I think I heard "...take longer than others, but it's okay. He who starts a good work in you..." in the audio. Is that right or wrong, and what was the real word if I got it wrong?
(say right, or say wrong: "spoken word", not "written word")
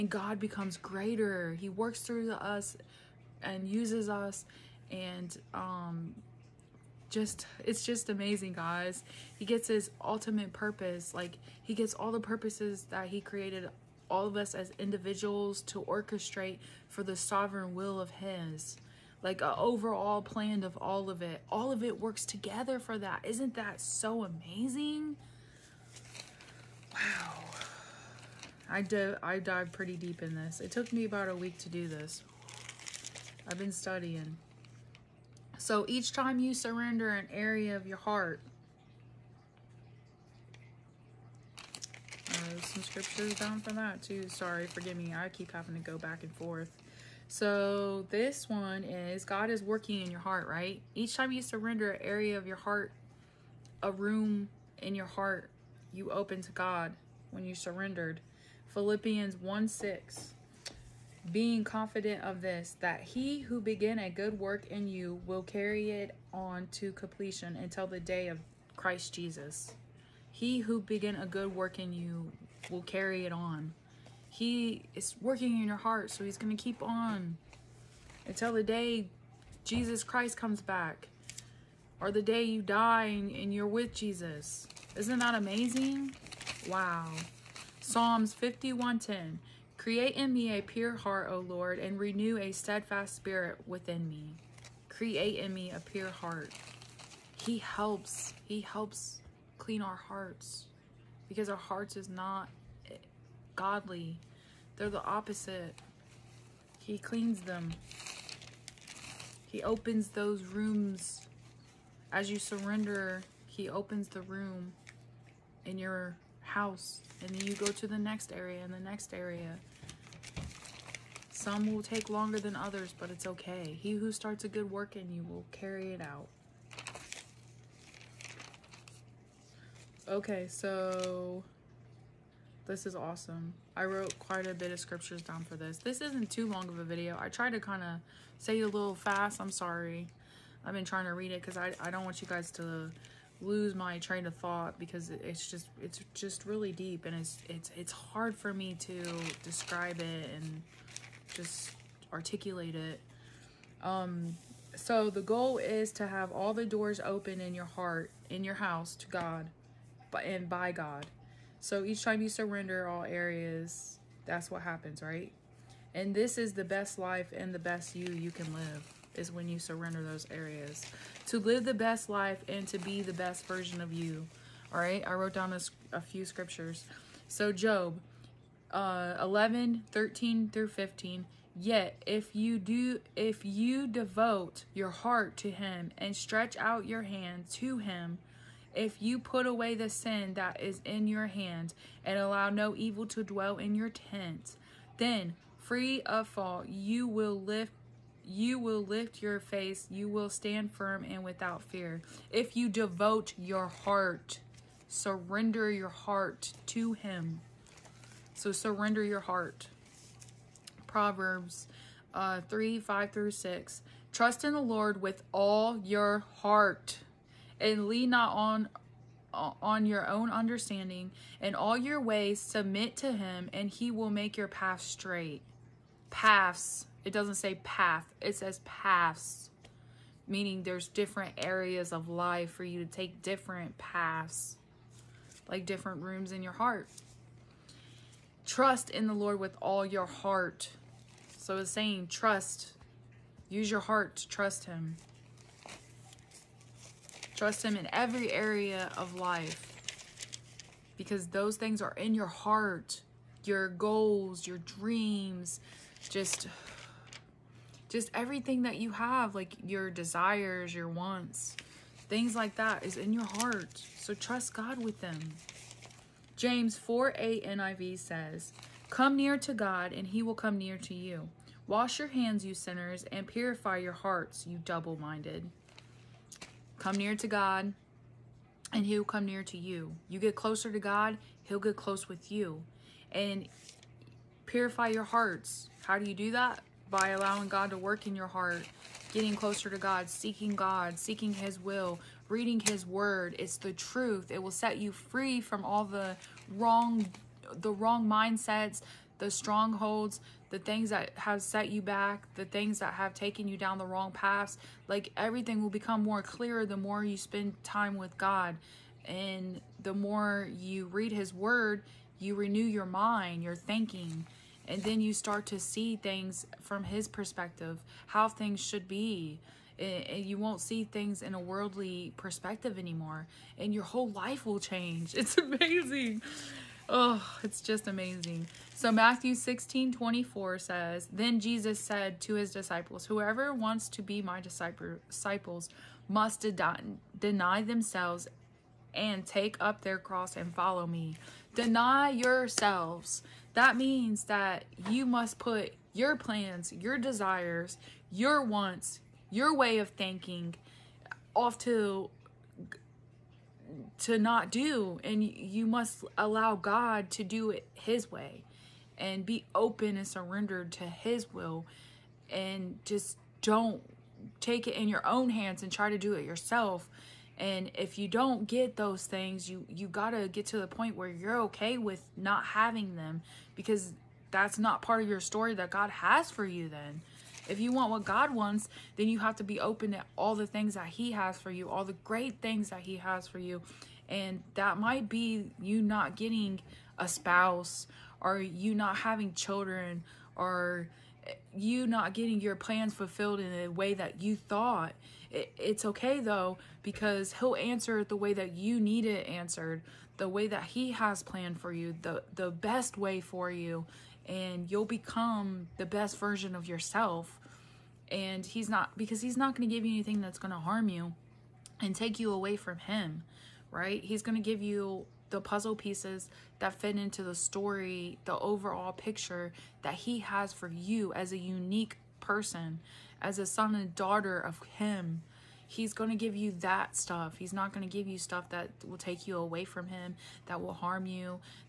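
right.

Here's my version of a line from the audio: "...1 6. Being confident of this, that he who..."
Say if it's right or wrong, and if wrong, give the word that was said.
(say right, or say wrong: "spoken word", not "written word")
right.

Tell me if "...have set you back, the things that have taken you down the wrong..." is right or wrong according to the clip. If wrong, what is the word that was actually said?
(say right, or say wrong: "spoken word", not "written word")
right.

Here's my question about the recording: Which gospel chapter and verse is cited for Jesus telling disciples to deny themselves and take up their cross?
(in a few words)
Matthew 16:24.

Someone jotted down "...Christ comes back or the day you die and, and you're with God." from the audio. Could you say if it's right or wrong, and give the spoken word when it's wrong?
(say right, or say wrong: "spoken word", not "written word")
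wrong: "Jesus", not "God".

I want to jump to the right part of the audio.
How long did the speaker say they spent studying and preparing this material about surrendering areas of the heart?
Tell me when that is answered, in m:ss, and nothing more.
0:31.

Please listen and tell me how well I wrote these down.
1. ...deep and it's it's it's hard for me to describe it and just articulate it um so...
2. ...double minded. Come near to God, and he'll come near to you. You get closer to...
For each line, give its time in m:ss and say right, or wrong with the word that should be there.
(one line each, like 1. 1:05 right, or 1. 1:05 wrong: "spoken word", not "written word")
1. 2:26 right
2. 4:34 right.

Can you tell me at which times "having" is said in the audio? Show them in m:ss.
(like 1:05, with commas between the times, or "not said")
0:45, 6:12, 6:28.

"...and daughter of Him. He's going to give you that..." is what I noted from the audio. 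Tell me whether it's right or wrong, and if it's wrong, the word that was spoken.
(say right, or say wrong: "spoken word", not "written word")
right.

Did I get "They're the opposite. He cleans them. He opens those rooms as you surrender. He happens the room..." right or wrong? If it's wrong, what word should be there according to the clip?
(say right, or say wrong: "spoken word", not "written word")
wrong: "opens", not "happens".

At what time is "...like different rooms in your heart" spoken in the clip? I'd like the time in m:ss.
3:55.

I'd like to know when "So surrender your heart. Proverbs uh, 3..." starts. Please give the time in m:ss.
3:28.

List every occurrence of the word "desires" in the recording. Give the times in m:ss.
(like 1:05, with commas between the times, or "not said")
4:19, 5:46.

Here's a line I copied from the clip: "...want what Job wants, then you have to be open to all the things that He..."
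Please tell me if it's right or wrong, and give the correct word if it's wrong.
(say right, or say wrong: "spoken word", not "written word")
wrong: "God", not "Job".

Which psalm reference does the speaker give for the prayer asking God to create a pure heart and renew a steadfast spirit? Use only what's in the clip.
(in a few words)
Psalms 51:10.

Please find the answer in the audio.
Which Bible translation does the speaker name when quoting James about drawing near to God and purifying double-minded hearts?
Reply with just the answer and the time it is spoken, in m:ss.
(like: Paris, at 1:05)
NIV, at 4:27.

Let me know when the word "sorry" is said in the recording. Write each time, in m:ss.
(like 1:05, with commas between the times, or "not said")
0:44, 2:19.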